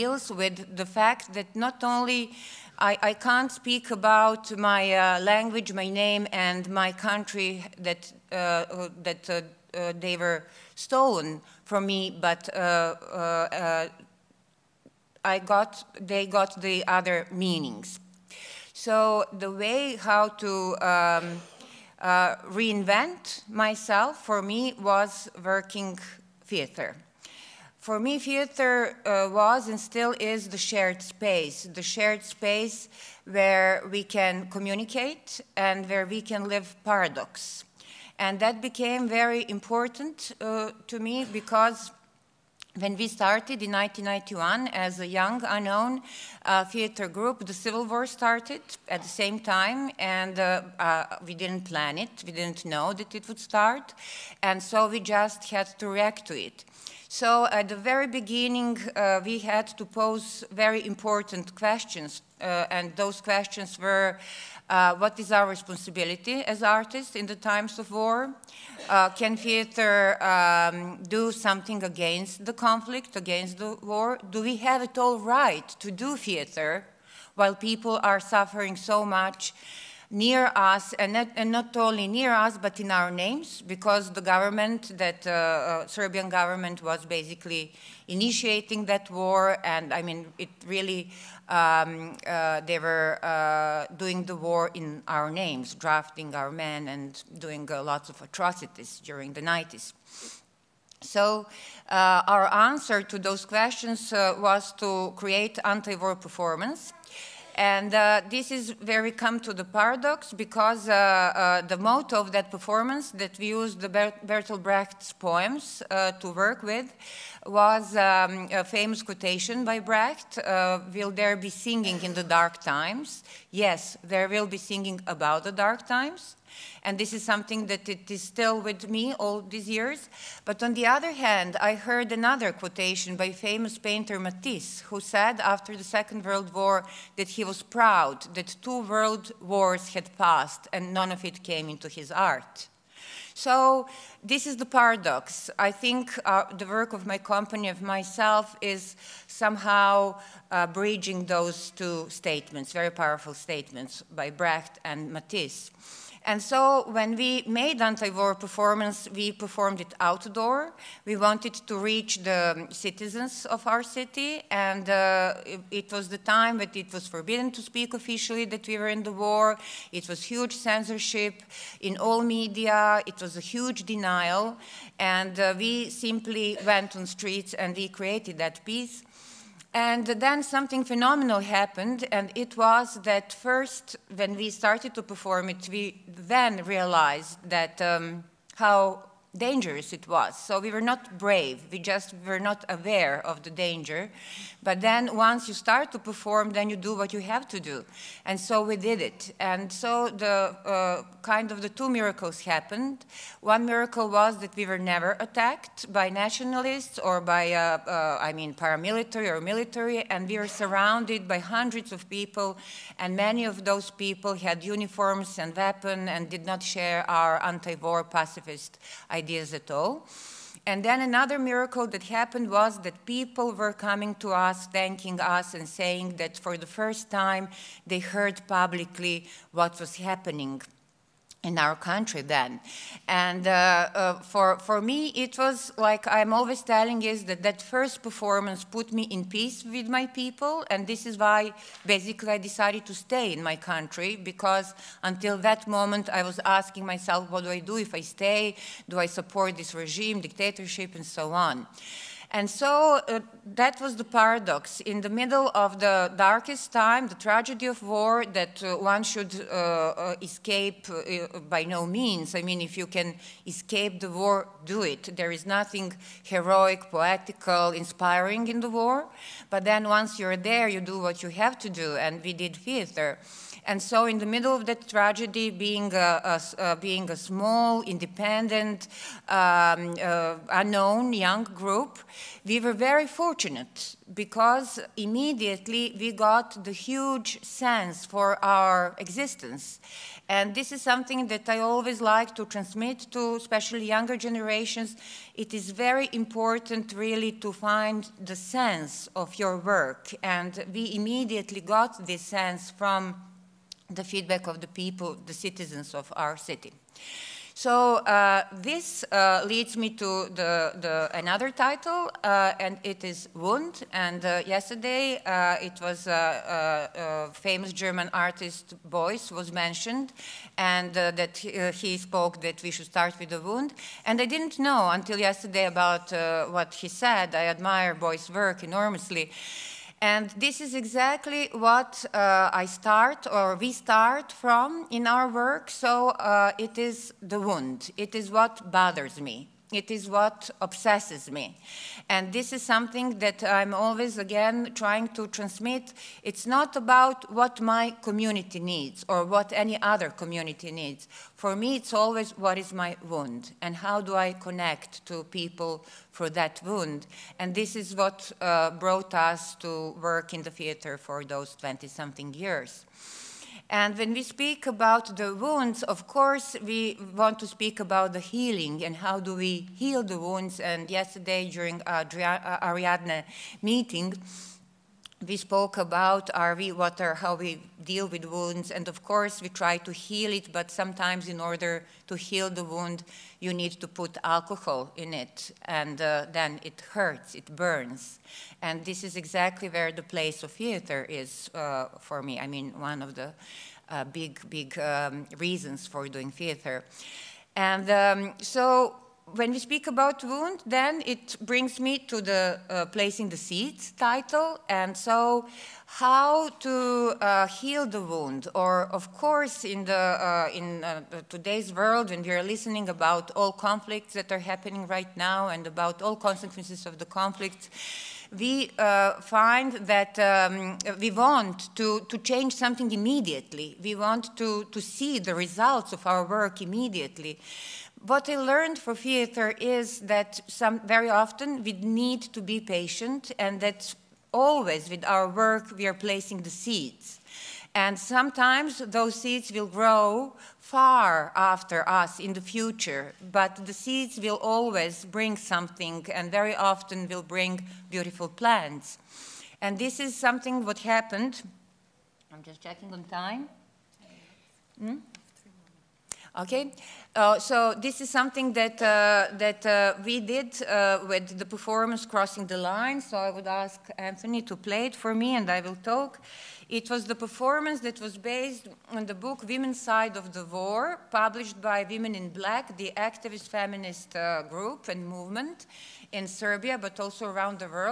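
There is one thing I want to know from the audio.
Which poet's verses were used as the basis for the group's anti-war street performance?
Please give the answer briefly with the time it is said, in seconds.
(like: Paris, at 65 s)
Bertolt Brecht, at 113 s.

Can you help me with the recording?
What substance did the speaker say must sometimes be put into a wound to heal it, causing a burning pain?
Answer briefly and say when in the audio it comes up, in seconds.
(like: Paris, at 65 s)
alcohol, at 384 s.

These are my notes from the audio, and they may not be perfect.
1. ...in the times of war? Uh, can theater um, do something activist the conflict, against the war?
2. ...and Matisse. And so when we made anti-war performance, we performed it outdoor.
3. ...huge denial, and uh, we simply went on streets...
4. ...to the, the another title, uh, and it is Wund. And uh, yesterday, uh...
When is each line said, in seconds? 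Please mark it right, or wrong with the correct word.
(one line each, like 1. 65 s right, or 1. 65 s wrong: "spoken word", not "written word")
1. 67 s wrong: "against", not "activist"
2. 154 s right
3. 173 s right
4. 309 s right.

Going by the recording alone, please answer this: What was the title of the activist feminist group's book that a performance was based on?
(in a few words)
Women's Side of the War.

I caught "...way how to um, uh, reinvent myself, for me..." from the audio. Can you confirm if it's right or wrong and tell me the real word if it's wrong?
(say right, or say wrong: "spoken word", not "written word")
right.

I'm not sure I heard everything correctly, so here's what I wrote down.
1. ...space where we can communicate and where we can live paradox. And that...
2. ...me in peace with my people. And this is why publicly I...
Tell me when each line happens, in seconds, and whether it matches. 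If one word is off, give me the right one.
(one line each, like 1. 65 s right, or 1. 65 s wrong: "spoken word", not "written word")
1. 32 s right
2. 238 s wrong: "basically", not "publicly".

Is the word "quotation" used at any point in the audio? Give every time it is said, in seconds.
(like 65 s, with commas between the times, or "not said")
119 s, 132 s.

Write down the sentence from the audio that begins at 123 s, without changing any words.
Yes, there will be singing about the dark times.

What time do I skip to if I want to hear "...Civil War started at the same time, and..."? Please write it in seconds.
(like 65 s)
47 s.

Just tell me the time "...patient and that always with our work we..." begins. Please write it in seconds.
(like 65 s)
432 s.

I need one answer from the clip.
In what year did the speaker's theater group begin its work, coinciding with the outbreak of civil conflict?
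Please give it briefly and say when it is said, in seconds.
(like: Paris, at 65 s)
1991, at 43 s.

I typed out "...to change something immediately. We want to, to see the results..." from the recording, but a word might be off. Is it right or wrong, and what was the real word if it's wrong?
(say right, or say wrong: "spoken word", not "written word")
right.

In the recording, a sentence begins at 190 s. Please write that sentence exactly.
So we were not brave, we just were not aware of the danger.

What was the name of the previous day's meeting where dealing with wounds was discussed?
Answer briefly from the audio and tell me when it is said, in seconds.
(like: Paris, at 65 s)
Ariadne meeting, at 371 s.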